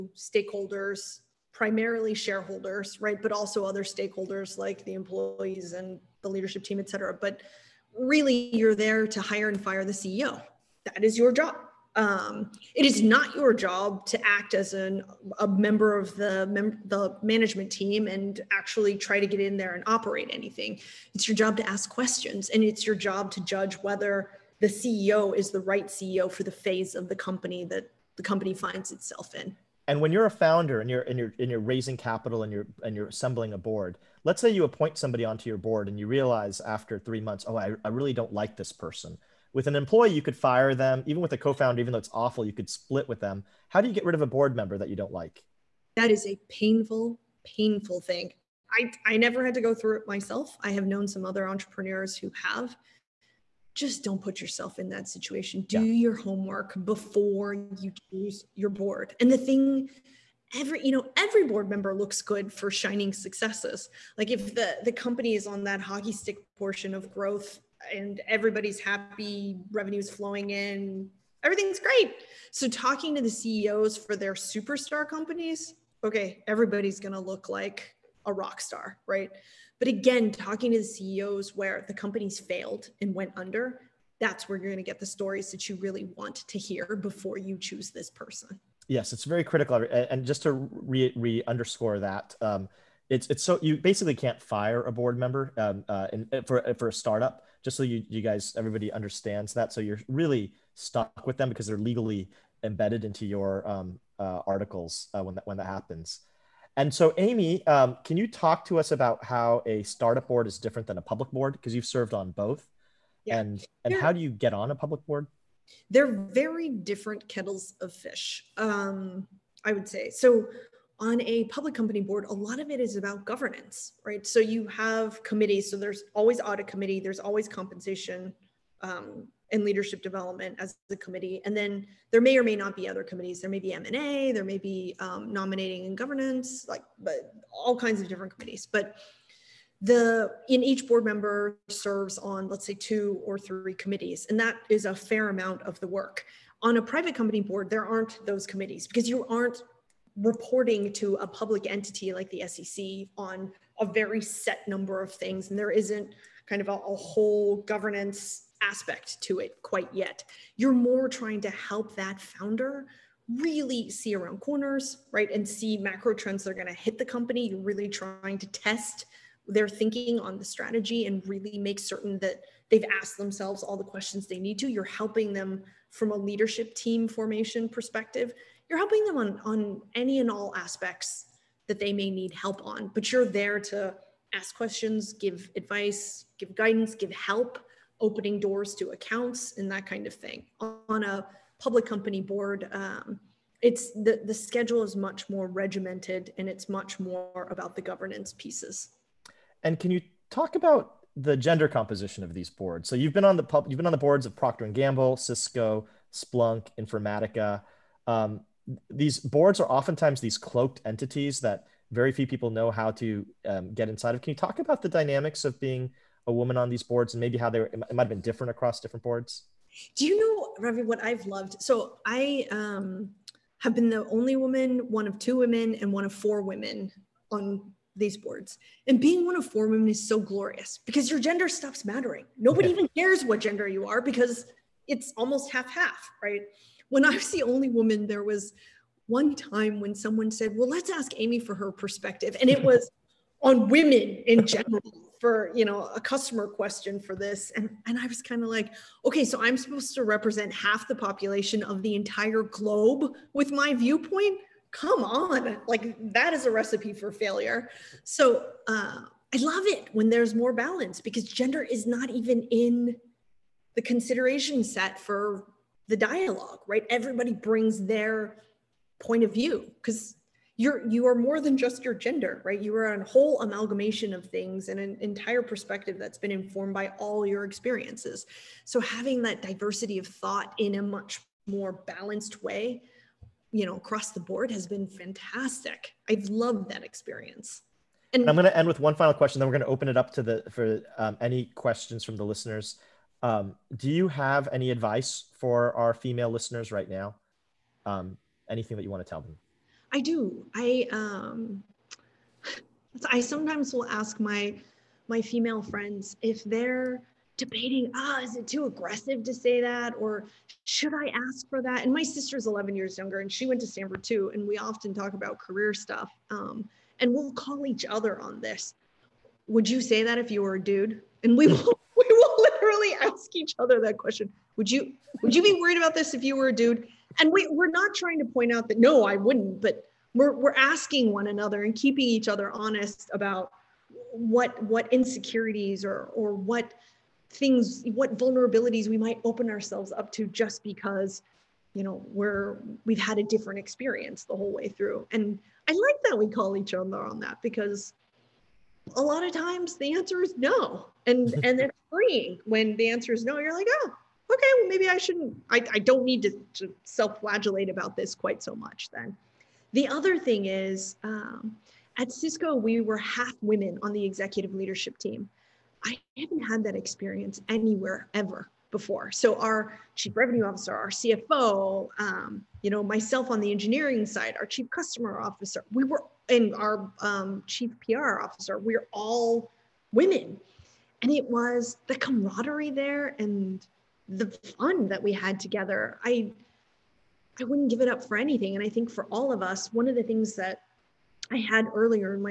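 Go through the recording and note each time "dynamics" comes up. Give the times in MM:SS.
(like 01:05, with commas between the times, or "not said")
03:34.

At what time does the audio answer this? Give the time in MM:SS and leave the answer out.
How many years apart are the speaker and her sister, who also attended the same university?
05:12.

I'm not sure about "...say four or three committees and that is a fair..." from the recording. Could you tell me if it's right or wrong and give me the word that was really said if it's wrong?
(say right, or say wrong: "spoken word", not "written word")
wrong: "two", not "four".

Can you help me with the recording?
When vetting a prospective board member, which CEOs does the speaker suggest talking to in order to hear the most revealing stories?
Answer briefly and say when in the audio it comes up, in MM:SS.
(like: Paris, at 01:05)
Where the companies failed, at 01:21.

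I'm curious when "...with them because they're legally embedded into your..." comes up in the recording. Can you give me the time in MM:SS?
01:41.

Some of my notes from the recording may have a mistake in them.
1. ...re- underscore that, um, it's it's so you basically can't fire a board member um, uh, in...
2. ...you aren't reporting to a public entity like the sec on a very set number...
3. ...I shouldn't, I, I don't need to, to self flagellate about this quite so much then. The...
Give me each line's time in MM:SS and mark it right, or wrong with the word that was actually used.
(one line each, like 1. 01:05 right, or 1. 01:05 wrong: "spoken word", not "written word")
1. 01:31 right
2. 02:29 right
3. 05:54 right.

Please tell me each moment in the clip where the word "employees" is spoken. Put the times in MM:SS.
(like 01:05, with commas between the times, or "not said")
00:04, 00:39.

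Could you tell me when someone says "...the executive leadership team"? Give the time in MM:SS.
06:03.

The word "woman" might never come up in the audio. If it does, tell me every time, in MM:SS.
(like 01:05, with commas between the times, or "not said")
03:36, 03:44, 03:57.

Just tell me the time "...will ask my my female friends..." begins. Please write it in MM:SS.
05:03.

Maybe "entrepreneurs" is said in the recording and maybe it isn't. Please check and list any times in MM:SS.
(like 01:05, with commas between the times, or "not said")
00:51.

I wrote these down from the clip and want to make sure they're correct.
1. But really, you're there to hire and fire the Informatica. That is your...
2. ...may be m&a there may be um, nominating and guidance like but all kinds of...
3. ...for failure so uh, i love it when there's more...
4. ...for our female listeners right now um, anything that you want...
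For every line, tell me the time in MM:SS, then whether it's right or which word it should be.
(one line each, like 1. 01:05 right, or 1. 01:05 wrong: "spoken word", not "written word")
1. 00:07 wrong: "CEO", not "Informatica"
2. 02:13 wrong: "governance", not "guidance"
3. 04:16 right
4. 04:55 right.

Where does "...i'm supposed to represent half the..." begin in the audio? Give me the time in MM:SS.
04:09.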